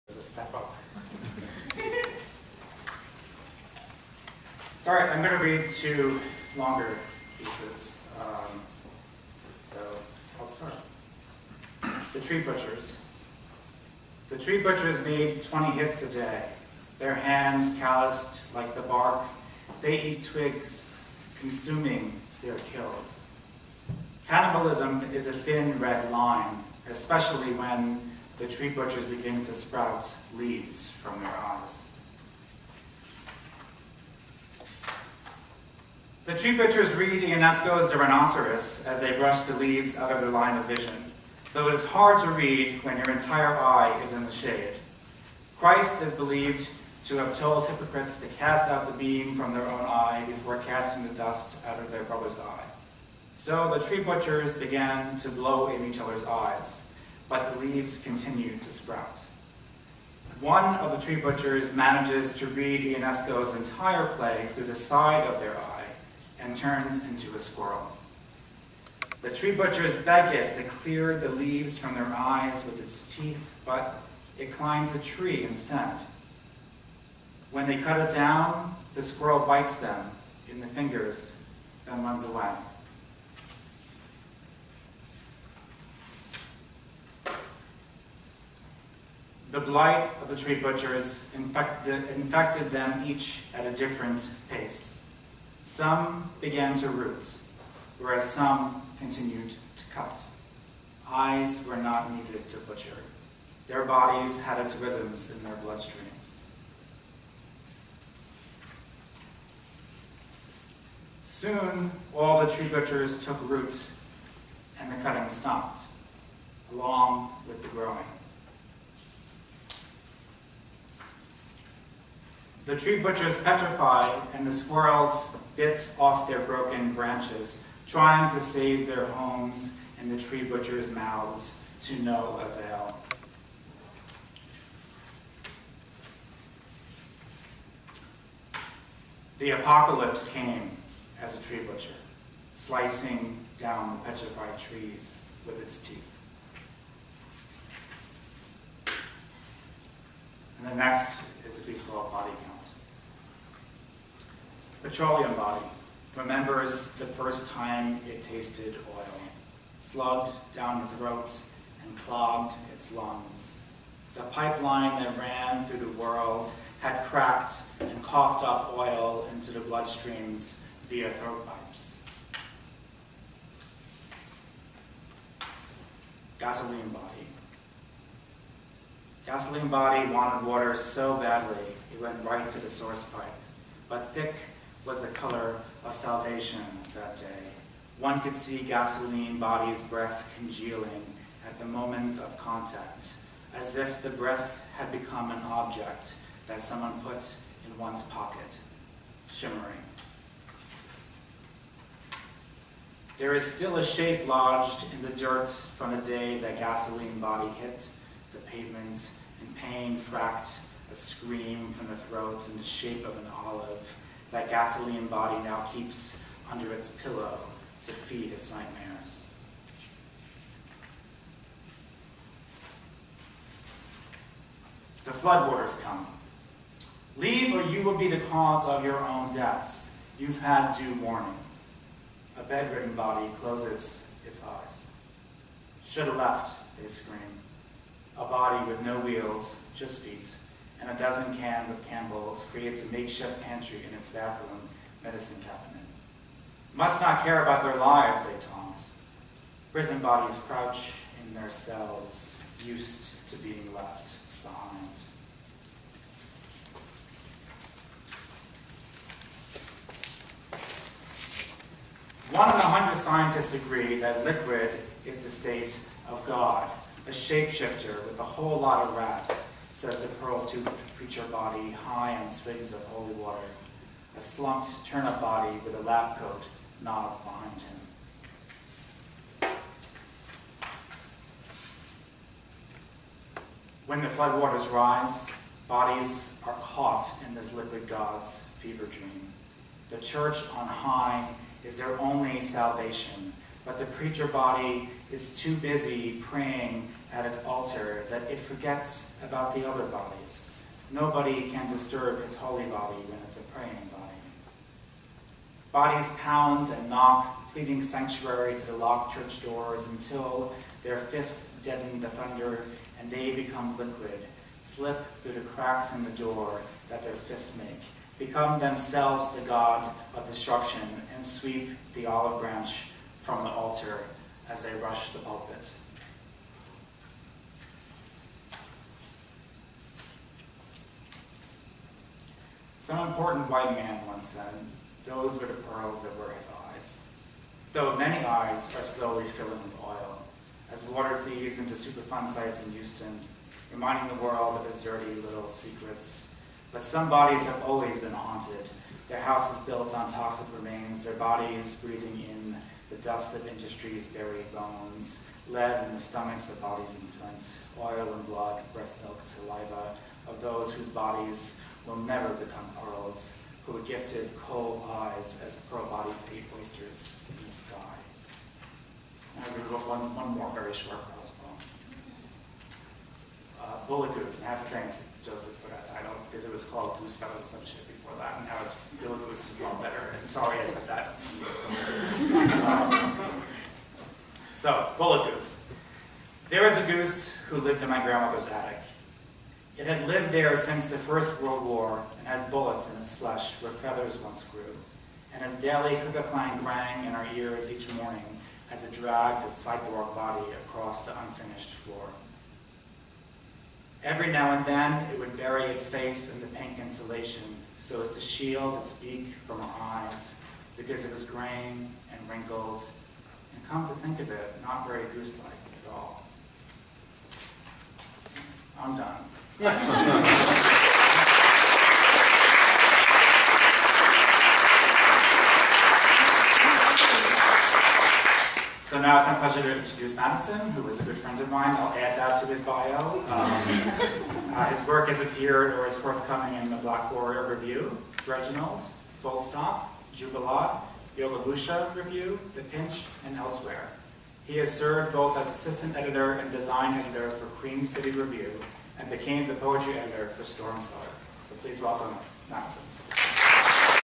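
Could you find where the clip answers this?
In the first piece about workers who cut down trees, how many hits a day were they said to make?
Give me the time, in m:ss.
0:15.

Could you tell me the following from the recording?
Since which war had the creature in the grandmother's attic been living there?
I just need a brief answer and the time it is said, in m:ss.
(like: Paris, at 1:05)
First World War, at 6:30.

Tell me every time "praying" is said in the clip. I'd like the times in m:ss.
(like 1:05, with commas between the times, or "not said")
4:56, 5:03.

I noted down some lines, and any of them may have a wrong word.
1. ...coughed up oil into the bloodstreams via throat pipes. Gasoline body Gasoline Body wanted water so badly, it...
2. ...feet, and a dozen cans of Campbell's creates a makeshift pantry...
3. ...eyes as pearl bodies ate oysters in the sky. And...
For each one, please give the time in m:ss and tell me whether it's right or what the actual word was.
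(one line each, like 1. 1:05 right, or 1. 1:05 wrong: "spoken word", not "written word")
1. 2:48 right
2. 4:00 right
3. 6:04 right.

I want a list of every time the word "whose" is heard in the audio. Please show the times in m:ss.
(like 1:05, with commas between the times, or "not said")
6:00.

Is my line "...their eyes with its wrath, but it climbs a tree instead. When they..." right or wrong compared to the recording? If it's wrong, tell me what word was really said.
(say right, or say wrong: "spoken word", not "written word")
wrong: "teeth", not "wrath".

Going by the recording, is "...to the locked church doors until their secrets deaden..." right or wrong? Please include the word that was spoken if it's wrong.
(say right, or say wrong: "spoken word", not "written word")
wrong: "fists", not "secrets".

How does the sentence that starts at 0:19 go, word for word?
They eat twigs, consuming their kills.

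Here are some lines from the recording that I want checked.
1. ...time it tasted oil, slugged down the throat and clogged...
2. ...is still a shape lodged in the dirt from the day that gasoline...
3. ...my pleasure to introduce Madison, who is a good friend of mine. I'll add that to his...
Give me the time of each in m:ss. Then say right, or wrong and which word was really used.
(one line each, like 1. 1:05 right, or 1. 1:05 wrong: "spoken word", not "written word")
1. 2:37 right
2. 3:23 right
3. 7:09 right.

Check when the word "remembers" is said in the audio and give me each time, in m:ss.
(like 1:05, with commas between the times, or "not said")
2:36.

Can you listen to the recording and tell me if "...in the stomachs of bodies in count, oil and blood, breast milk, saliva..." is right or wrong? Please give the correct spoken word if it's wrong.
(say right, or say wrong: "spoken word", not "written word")
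wrong: "flint", not "count".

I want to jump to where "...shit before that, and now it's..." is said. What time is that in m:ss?
6:17.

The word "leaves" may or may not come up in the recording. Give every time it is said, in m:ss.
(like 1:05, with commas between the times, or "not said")
0:30, 0:39, 0:57, 1:11, 3:47.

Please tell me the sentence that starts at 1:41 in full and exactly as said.
Eyes were not needed to butcher.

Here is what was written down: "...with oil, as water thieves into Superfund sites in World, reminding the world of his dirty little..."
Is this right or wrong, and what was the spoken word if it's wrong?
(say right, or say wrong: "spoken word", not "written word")
wrong: "Houston", not "World".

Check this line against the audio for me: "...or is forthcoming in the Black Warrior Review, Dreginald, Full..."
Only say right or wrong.
right.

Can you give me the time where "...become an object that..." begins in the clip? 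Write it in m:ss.
3:14.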